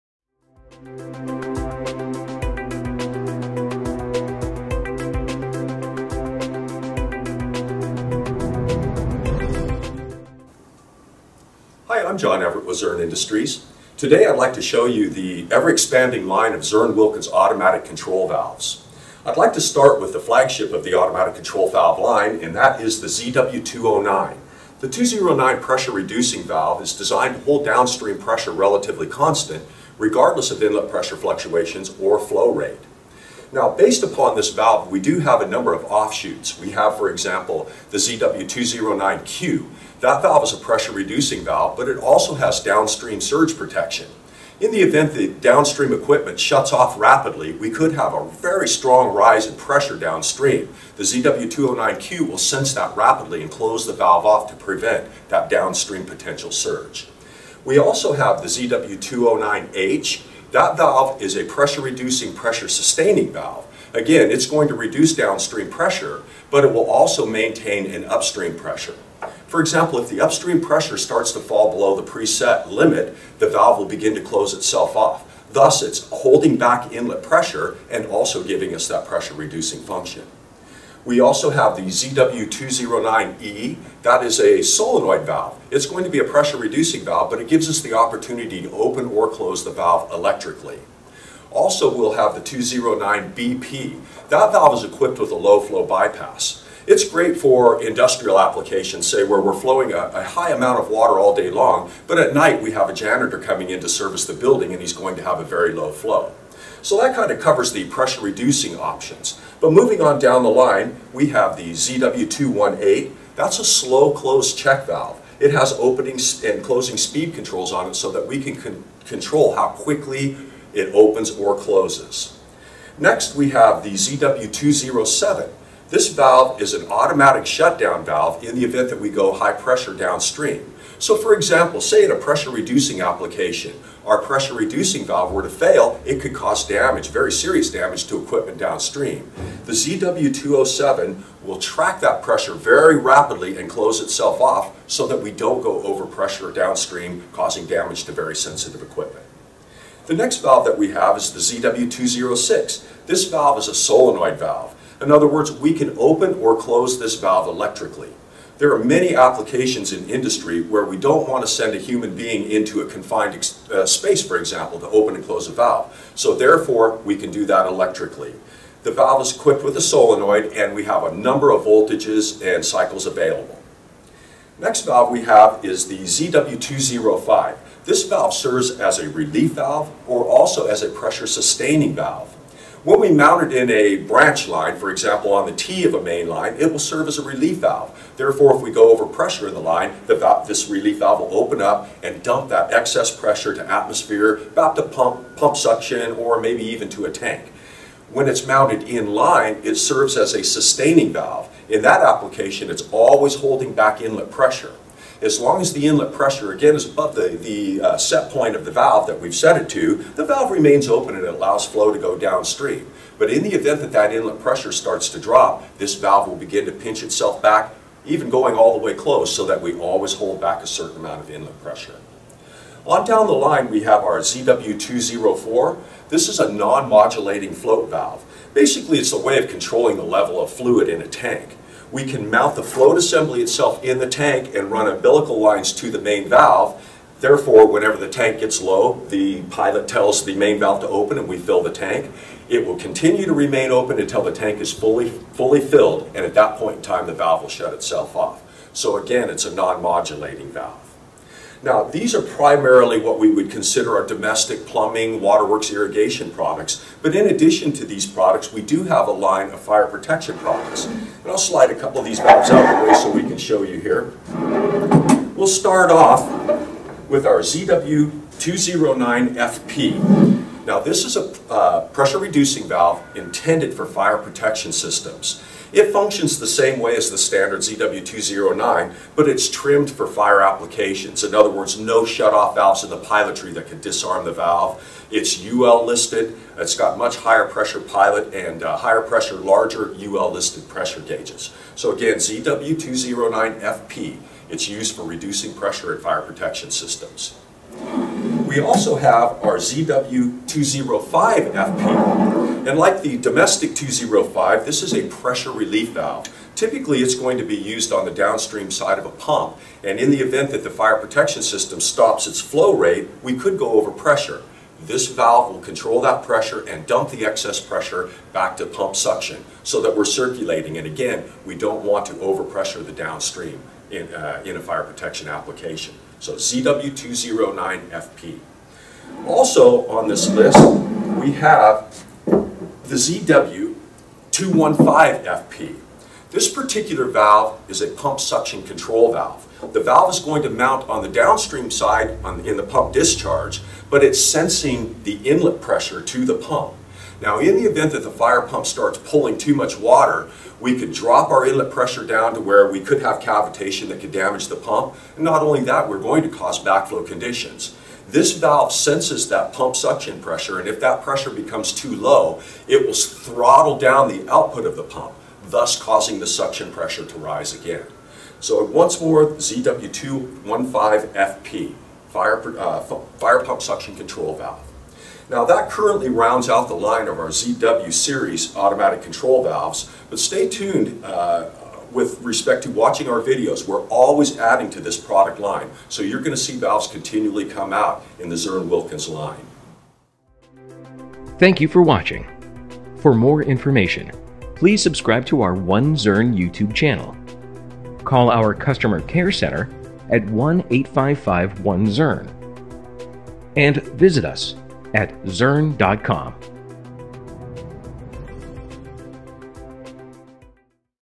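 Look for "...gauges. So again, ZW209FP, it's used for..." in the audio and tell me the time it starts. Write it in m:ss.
4:50.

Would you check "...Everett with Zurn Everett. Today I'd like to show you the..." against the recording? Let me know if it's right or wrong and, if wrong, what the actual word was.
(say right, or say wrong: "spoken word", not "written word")
wrong: "Industries", not "Everett".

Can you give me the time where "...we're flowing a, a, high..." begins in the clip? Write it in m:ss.
1:39.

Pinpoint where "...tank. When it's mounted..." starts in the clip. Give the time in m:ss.
3:17.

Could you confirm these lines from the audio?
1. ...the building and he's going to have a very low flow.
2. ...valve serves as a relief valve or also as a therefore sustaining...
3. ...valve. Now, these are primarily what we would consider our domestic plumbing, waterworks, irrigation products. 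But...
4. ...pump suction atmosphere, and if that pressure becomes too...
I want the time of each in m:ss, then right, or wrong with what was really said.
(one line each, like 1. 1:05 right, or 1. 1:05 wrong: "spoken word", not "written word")
1. 1:44 right
2. 2:58 wrong: "pressure", not "therefore"
3. 4:10 right
4. 5:59 wrong: "pressure", not "atmosphere".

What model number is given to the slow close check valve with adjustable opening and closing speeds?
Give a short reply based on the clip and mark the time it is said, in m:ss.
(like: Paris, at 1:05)
ZW218, at 1:51.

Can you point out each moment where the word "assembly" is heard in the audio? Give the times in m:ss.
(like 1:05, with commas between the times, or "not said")
3:52.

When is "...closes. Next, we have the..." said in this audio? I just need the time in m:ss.
2:01.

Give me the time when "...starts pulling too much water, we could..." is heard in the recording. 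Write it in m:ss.
5:48.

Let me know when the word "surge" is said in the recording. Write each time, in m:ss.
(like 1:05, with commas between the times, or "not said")
0:43, 0:56.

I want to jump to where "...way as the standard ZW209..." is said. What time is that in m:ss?
4:36.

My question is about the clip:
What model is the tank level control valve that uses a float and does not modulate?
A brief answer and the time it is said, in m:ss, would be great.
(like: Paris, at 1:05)
ZW204, at 3:44.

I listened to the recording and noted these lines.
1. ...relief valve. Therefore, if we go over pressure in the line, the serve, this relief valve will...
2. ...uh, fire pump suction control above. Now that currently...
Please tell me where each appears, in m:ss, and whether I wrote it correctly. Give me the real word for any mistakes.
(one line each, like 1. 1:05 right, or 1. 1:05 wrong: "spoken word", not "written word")
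1. 3:07 wrong: "valve", not "serve"
2. 6:12 wrong: "valve", not "above".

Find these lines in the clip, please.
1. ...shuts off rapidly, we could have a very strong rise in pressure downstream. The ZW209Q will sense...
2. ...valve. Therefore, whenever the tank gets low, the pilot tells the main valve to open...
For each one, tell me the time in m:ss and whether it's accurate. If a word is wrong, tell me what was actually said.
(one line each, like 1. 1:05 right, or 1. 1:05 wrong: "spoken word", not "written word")
1. 0:46 right
2. 3:56 right.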